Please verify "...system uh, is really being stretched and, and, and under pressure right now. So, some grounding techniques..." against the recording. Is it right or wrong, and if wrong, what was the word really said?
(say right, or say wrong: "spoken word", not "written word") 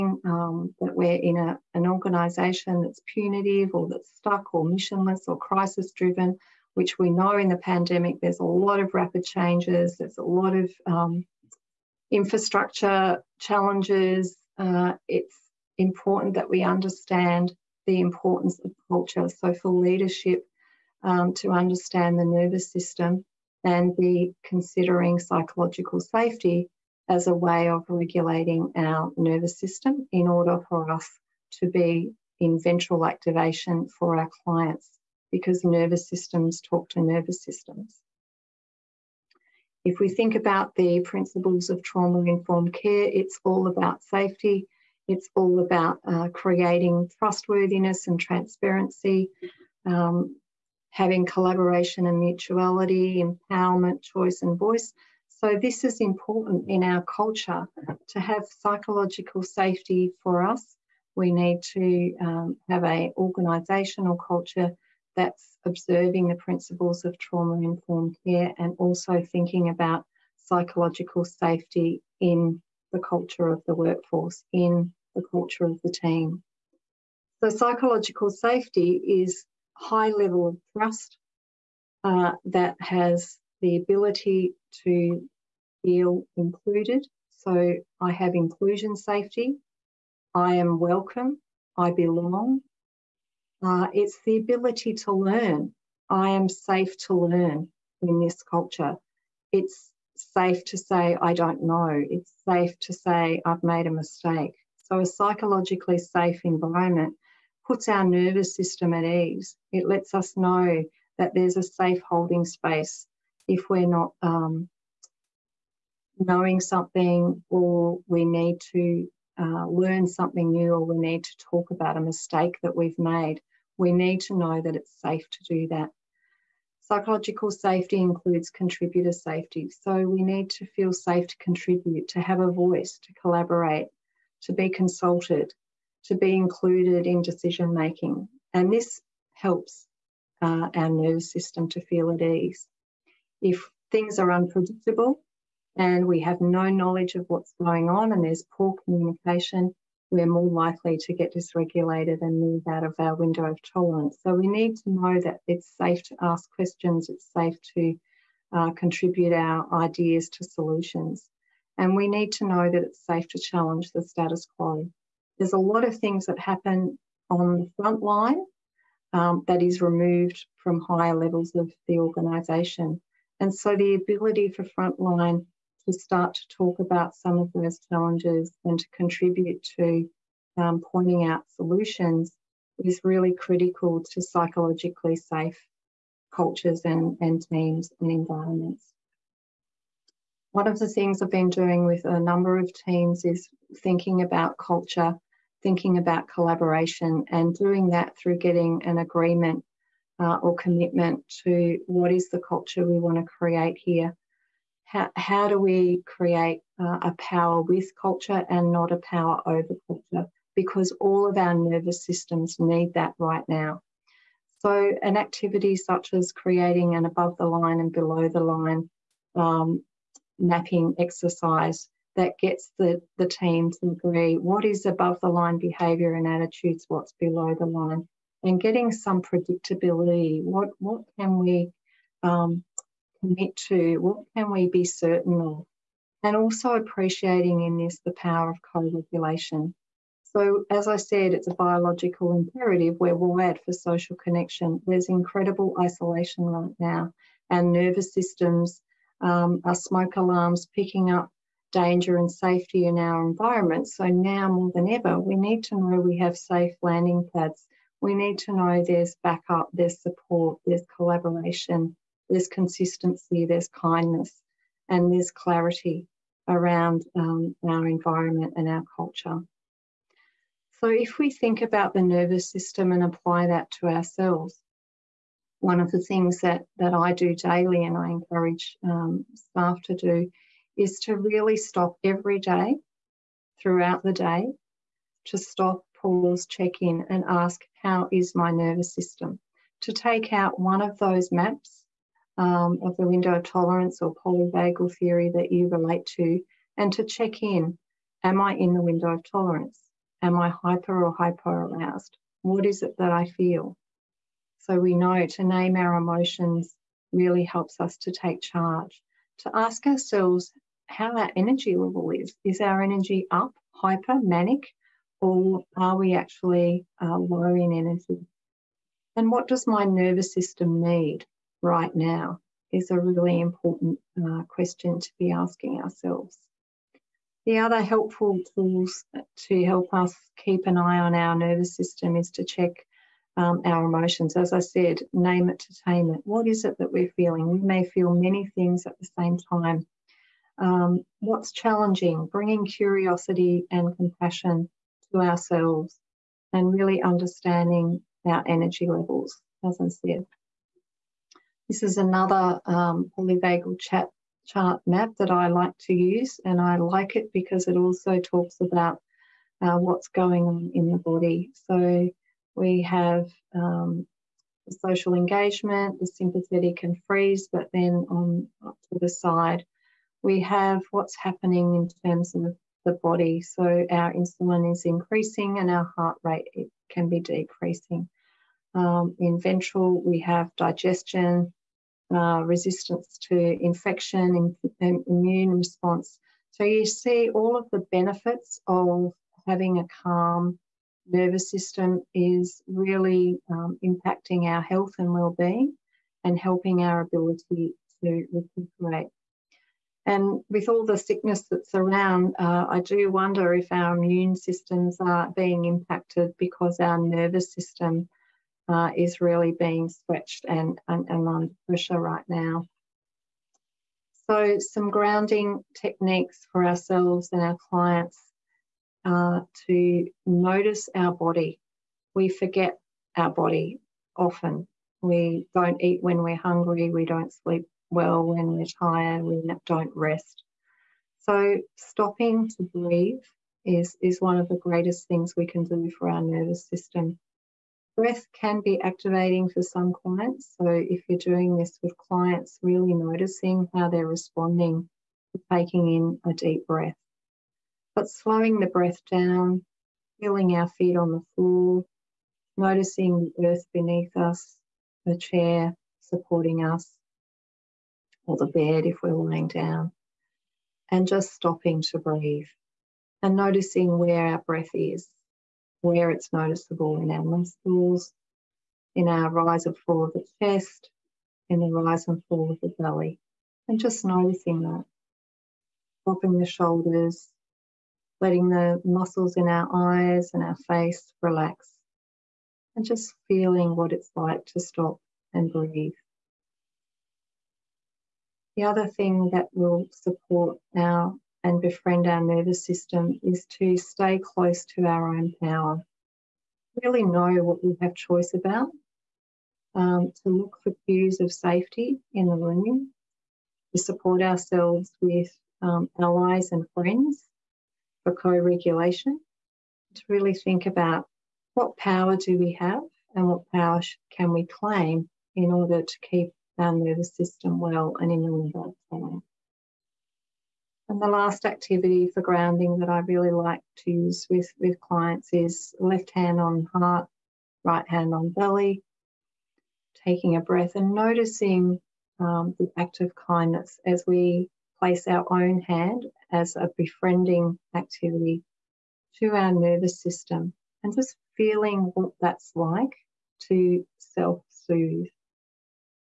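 right.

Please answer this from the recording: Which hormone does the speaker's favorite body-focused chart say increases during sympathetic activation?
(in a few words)
insulin.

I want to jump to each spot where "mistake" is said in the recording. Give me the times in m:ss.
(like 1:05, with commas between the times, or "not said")
1:43, 2:02.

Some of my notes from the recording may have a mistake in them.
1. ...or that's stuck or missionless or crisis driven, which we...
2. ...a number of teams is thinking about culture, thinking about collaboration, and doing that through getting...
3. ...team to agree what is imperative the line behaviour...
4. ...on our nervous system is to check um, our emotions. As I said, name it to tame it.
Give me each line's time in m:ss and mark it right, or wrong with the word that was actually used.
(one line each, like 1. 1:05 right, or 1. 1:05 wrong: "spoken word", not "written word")
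1. 0:03 right
2. 3:12 right
3. 3:43 wrong: "above", not "imperative"
4. 5:30 right.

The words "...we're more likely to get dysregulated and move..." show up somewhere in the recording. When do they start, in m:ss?
2:30.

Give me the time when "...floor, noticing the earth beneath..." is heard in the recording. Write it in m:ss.
7:31.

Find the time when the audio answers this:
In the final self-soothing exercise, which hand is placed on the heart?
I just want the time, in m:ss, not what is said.
8:45.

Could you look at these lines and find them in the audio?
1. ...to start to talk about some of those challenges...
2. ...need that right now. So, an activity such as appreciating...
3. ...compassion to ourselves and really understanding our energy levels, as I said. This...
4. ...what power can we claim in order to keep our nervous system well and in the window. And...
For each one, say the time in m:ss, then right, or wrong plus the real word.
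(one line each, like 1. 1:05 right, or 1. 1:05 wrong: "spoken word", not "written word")
1. 2:55 right
2. 3:32 wrong: "creating", not "appreciating"
3. 5:43 right
4. 8:33 right.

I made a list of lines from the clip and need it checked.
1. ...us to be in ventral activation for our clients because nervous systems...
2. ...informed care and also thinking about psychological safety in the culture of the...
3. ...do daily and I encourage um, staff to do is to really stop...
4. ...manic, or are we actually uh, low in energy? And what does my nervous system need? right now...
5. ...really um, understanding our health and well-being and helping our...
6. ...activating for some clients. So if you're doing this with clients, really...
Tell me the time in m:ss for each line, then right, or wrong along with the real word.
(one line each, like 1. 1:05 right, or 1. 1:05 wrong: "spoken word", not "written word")
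1. 0:30 right
2. 1:07 right
3. 4:37 right
4. 5:14 right
5. 6:32 wrong: "impacting", not "understanding"
6. 7:18 right.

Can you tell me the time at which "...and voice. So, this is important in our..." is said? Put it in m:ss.
0:54.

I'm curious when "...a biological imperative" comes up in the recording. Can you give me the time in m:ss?
4:01.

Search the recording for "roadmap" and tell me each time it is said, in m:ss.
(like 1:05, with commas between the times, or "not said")
not said.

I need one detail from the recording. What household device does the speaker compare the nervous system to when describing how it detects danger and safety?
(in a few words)
smoke alarms.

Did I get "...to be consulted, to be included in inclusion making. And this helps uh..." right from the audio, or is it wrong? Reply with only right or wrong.
wrong.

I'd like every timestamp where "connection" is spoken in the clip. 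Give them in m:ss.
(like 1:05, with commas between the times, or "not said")
4:04.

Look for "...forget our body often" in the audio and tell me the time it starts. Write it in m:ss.
7:02.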